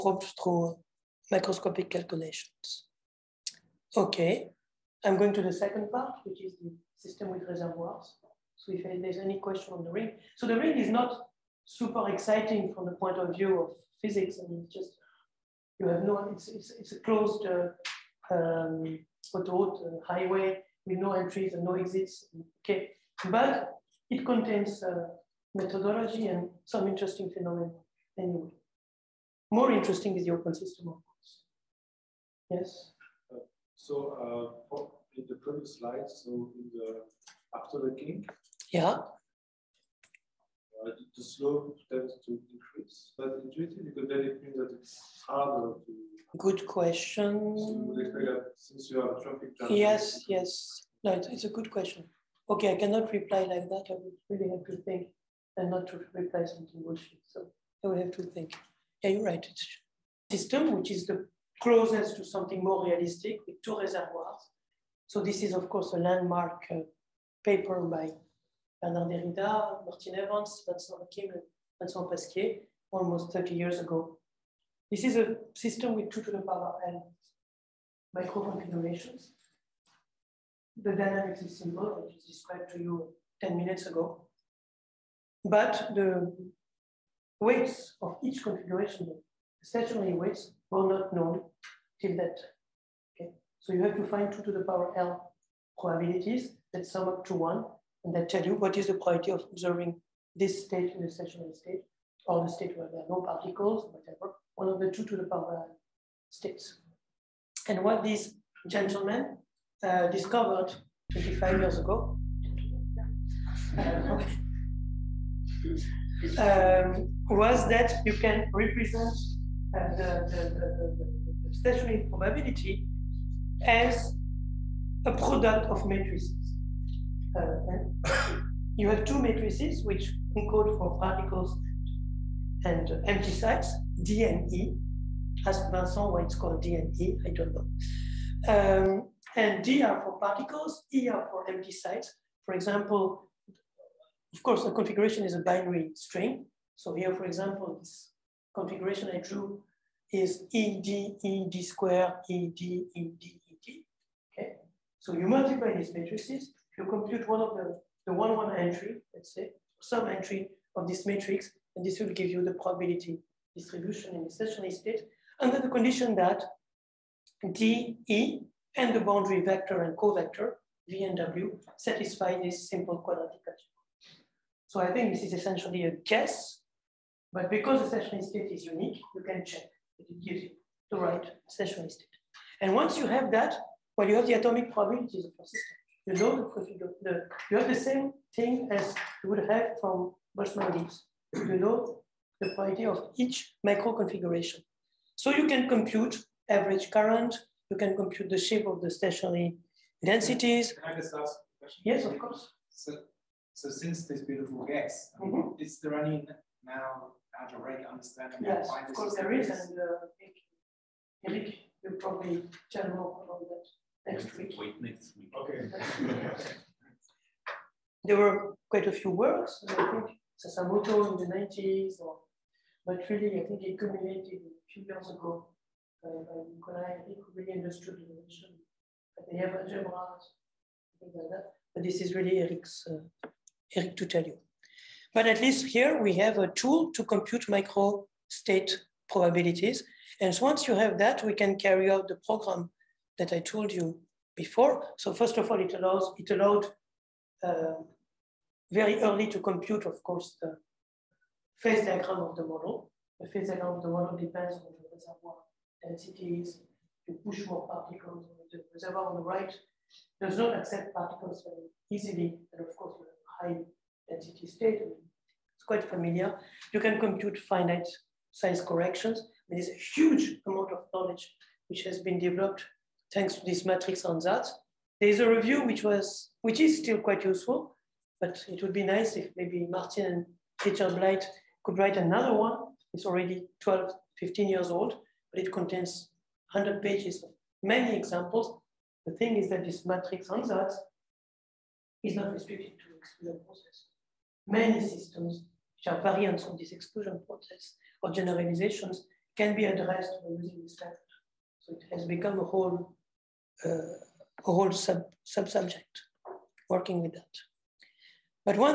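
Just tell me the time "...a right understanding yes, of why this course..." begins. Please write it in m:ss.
3:27.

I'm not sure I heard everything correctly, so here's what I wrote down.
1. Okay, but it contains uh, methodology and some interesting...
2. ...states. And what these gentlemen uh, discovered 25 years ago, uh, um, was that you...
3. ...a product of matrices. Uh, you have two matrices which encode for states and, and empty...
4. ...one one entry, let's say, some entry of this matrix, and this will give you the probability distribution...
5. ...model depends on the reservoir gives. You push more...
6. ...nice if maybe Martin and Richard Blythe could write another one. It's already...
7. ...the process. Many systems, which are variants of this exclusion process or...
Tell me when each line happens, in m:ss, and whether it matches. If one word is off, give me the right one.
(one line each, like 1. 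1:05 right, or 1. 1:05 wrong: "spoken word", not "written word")
1. 0:22 right
2. 1:46 right
3. 2:05 wrong: "particles", not "states"
4. 2:38 right
5. 4:13 wrong: "densities", not "gives"
6. 4:38 right
7. 4:53 right.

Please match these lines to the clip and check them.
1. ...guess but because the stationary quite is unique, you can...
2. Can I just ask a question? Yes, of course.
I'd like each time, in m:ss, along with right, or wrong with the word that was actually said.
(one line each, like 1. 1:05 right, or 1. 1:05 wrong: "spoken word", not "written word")
1. 2:55 wrong: "state", not "quite"
2. 3:20 right.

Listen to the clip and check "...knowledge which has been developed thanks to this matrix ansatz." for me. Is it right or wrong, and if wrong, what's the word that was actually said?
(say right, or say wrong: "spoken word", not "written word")
right.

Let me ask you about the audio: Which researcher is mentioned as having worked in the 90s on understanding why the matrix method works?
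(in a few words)
Sasamoto.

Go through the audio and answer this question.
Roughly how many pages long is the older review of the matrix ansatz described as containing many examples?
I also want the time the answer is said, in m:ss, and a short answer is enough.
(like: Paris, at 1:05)
100, at 4:46.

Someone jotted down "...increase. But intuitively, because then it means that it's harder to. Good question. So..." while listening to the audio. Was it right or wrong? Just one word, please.
right.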